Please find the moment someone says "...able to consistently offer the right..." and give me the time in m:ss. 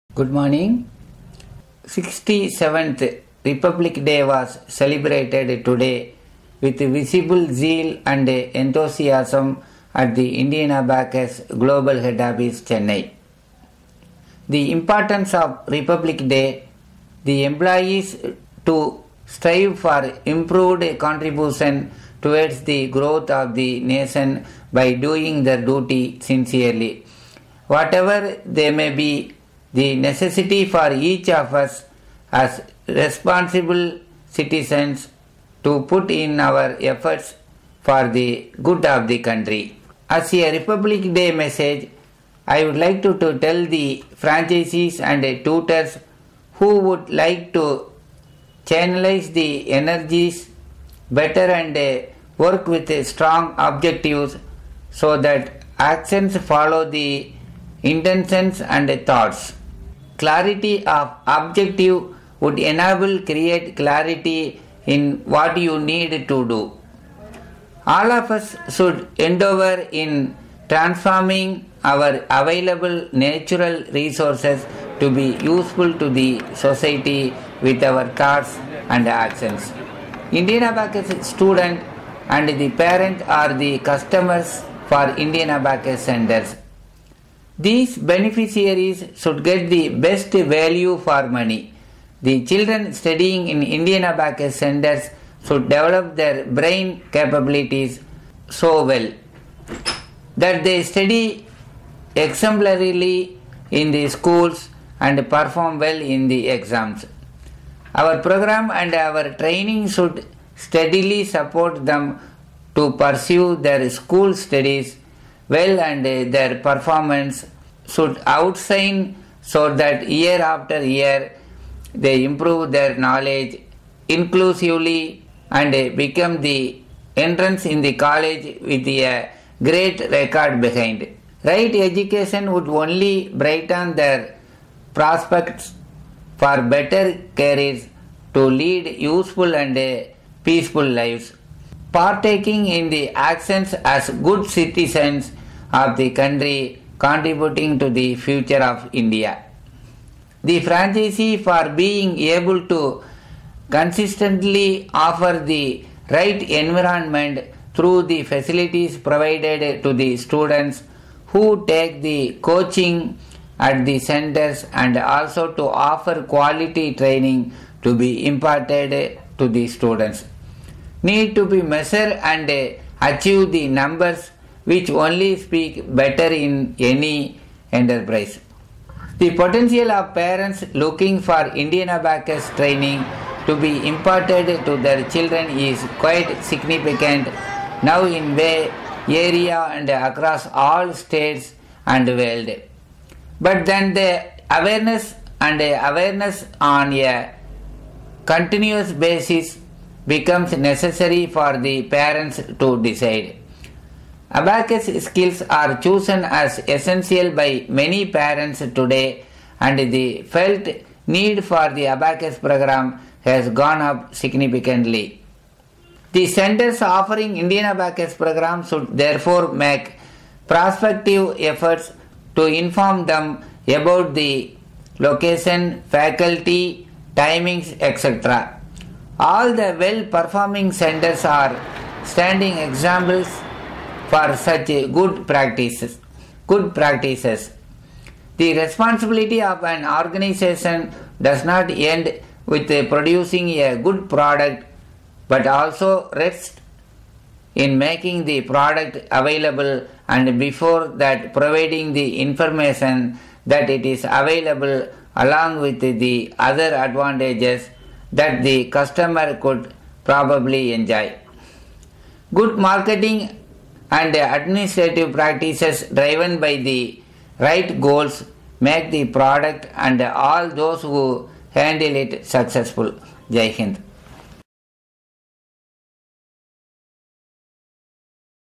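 2:32.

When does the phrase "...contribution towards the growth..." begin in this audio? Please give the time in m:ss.
0:20.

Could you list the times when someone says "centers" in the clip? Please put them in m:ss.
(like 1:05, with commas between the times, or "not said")
1:26, 1:34, 2:43, 3:36, 3:50.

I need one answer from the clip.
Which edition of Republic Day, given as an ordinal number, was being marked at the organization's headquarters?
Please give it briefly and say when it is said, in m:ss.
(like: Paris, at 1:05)
67th, at 0:01.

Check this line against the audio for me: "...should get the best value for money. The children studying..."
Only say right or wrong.
right.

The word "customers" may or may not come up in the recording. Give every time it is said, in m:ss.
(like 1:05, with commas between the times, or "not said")
1:23, 4:18.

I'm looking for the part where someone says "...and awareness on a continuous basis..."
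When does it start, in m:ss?
3:15.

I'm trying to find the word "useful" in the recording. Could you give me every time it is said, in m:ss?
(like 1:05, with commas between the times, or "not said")
1:15, 2:19.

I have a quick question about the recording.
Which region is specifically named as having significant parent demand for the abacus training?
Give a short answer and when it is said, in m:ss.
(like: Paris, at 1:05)
Bay Area, at 3:08.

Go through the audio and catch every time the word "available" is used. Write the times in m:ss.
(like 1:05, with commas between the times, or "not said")
1:12, 4:09, 4:14.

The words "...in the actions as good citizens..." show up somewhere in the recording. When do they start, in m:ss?
2:22.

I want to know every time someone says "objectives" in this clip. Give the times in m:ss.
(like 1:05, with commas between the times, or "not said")
0:53, 1:01.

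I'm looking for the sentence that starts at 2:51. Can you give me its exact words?
Need to be measured and achieve the numbers which only speak better in any enterprise.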